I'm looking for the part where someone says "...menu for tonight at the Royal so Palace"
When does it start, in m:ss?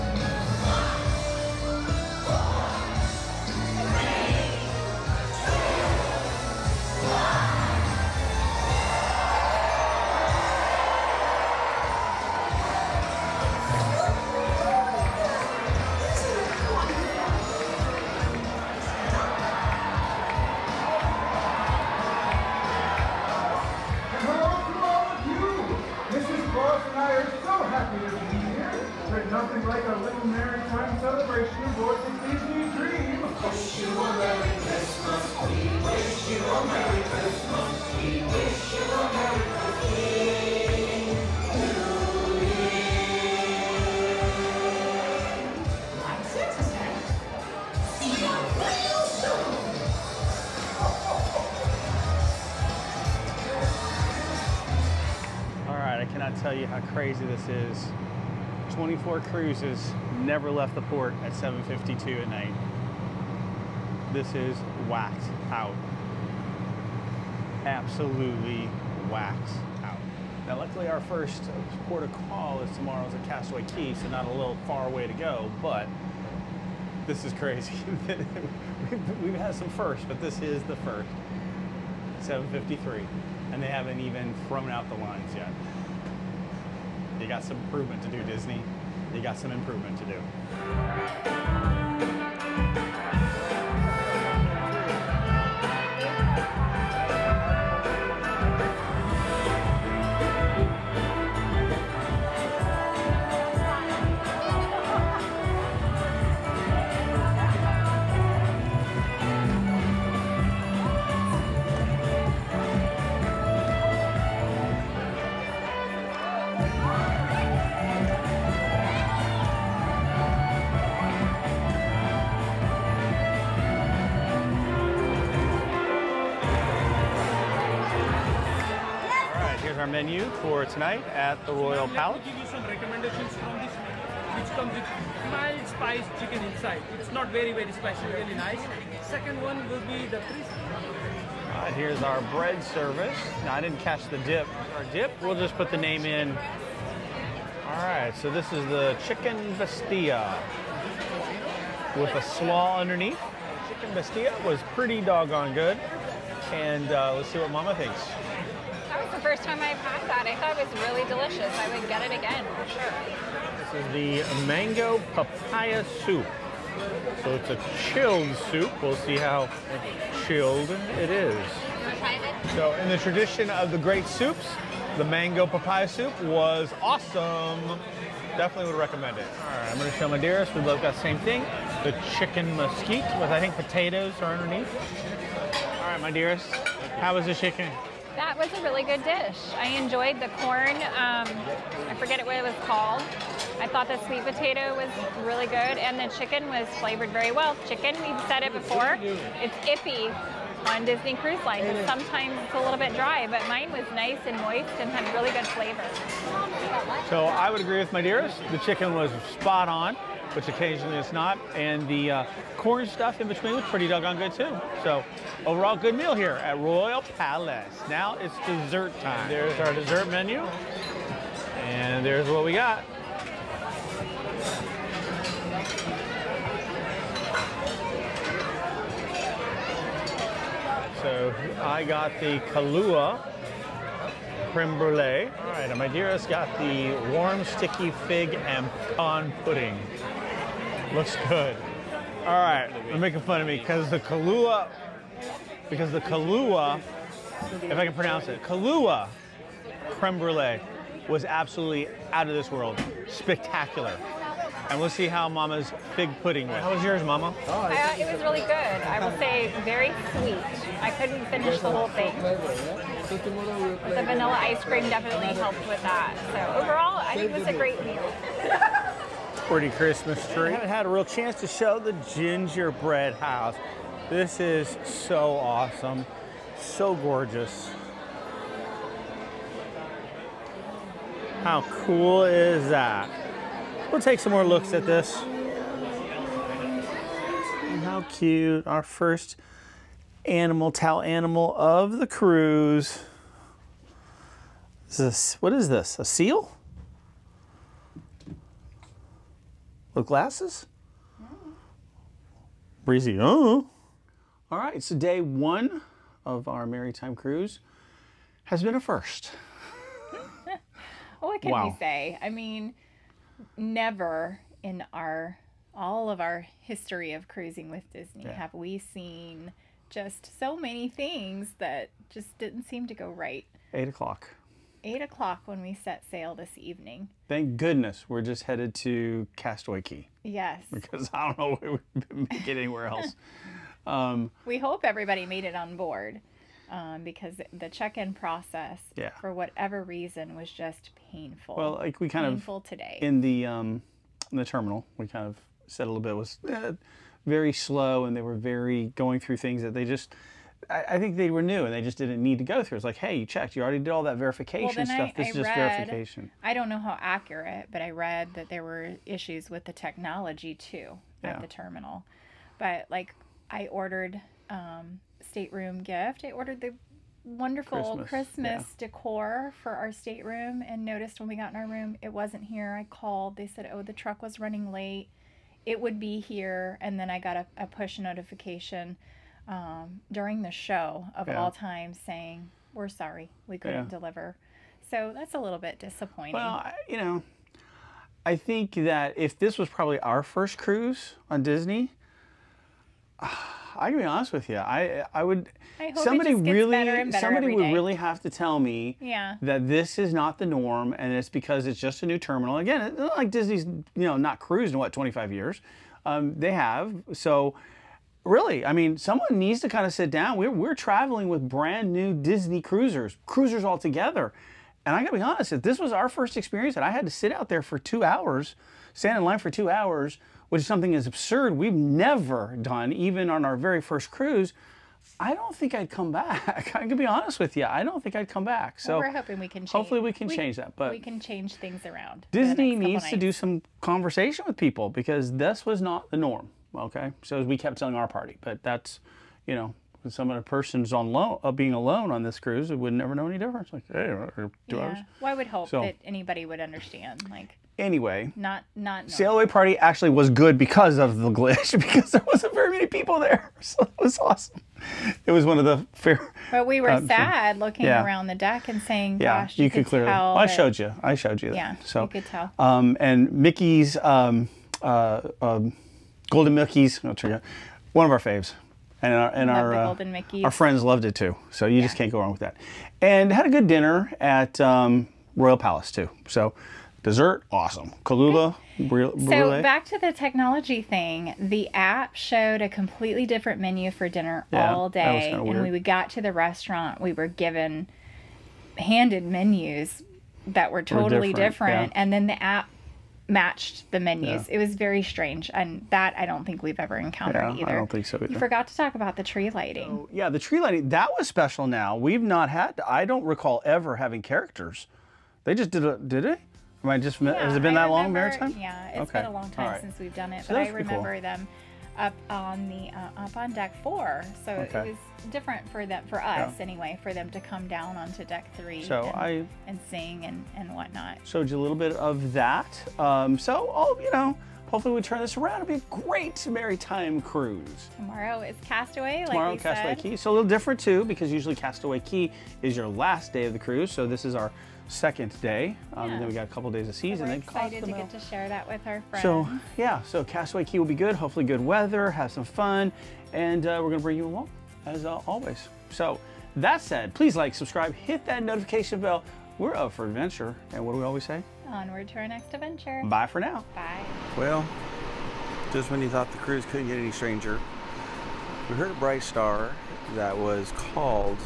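2:09.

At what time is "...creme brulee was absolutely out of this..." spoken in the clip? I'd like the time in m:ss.
4:09.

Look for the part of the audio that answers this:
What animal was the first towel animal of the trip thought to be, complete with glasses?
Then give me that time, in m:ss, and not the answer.
4:55.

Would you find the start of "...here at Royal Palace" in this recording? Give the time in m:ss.
3:36.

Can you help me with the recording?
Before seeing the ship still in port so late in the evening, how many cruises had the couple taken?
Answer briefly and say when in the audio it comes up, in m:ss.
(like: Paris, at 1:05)
24, at 0:58.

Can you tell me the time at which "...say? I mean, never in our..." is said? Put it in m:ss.
5:11.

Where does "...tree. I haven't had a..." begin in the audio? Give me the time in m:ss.
4:30.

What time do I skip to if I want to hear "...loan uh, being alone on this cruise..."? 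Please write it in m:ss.
7:21.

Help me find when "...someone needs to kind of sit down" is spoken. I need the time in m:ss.
6:48.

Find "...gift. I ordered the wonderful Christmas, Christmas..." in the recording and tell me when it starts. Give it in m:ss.
6:05.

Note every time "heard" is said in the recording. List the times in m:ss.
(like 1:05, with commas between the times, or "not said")
9:18.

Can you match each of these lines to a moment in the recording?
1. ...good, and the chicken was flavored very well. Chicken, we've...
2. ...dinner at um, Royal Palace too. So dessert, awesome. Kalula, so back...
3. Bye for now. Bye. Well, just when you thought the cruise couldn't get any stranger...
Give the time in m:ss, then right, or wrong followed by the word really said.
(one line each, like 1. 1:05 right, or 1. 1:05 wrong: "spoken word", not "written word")
1. 3:15 right
2. 7:53 right
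3. 9:13 right.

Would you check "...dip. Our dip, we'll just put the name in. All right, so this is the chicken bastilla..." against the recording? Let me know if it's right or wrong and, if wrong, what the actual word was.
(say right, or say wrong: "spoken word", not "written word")
right.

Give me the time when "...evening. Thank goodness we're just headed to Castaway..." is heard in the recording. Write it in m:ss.
5:26.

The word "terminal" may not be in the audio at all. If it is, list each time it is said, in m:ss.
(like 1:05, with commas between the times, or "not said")
5:44, 6:01, 6:42.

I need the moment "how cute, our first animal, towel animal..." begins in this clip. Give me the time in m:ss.
4:47.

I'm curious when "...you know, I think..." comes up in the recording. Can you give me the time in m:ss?
6:26.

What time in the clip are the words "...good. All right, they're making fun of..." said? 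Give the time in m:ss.
4:01.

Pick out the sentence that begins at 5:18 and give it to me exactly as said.
have we seen just so many things that just didn't seem to go right.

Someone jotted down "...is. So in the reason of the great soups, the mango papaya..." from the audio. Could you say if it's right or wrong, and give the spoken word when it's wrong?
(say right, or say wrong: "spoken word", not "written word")
wrong: "tradition", not "reason".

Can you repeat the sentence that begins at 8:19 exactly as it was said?
So, yeah, the tree lighting that was special.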